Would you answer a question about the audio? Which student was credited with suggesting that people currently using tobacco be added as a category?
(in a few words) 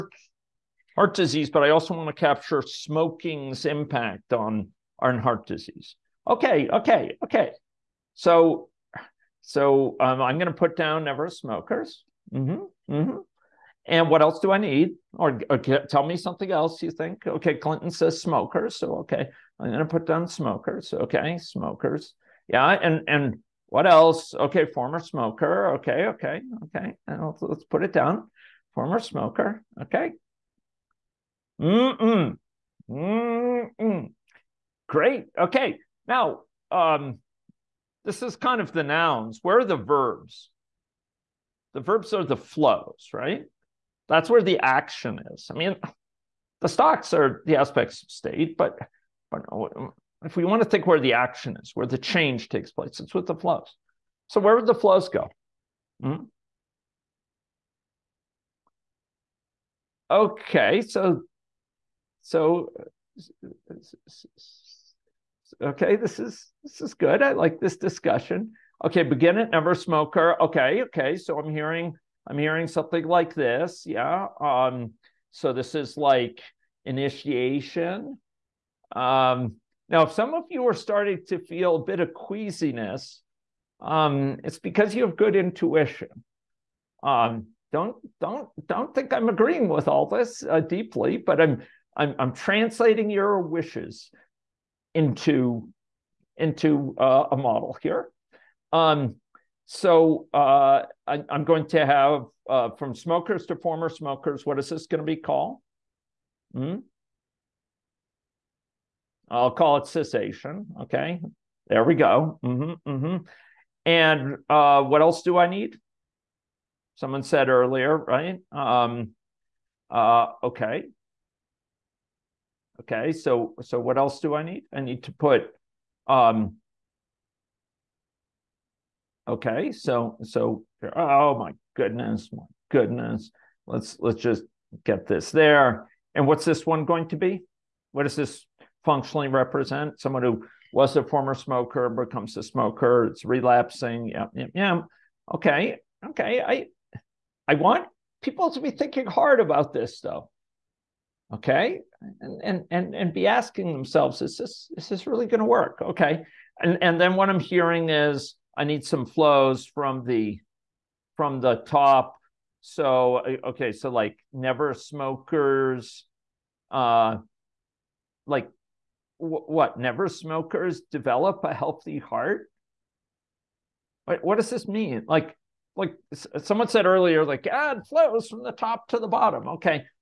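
Clinton.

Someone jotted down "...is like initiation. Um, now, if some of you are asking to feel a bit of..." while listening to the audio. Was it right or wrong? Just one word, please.
wrong.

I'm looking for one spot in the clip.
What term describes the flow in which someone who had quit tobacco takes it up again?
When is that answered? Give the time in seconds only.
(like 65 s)
143 s.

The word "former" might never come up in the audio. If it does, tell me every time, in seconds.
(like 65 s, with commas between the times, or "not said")
24 s, 28 s, 103 s, 141 s.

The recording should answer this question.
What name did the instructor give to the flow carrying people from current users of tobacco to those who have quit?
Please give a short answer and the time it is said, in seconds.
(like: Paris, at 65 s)
Cessation, at 109 s.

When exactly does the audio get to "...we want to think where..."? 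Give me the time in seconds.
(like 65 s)
50 s.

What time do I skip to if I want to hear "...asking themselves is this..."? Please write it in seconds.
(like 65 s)
153 s.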